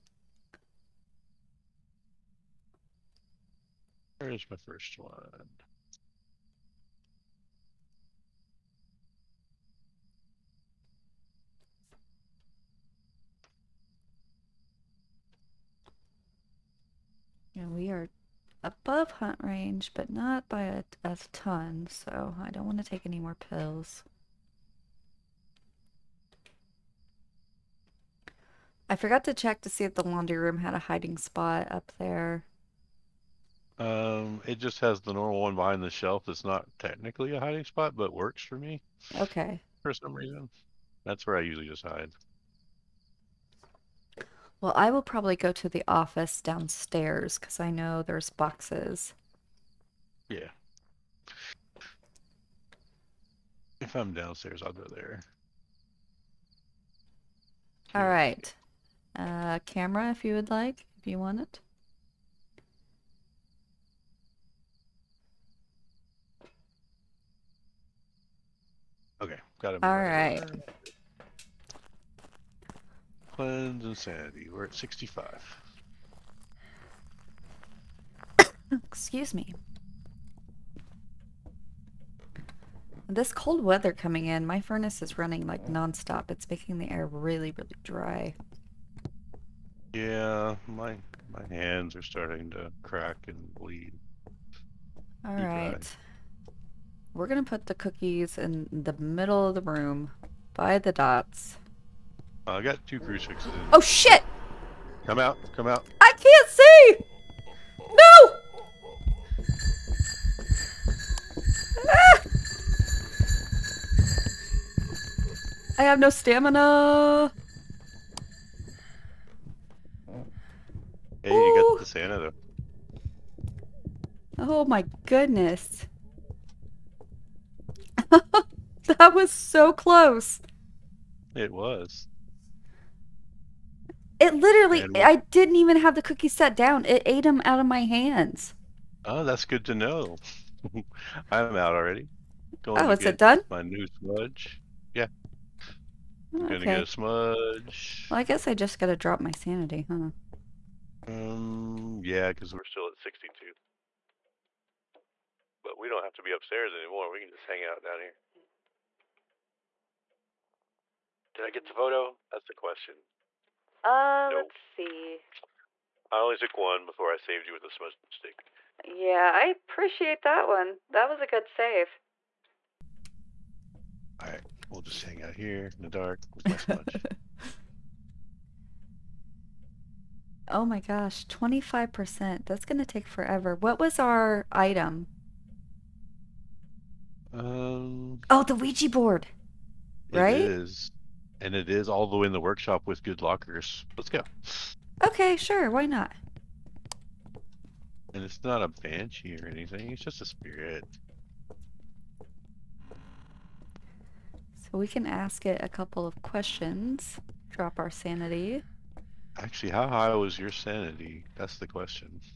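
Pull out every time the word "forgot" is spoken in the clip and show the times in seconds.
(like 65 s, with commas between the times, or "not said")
28 s.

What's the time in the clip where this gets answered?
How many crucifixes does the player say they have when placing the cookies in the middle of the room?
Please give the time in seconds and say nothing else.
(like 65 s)
102 s.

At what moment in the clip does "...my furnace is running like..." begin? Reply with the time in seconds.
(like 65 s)
84 s.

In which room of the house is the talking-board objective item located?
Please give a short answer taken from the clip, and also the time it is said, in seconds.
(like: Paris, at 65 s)
Workshop, at 192 s.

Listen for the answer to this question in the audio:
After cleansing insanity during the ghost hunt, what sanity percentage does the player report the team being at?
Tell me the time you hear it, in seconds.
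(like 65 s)
74 s.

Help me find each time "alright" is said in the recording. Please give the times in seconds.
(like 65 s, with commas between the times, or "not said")
95 s, 174 s.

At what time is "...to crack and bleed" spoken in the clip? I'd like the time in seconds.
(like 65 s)
92 s.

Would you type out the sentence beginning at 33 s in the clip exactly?
Um, it just has the normal one behind the shelf.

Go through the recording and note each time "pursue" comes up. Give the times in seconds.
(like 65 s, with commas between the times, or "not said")
not said.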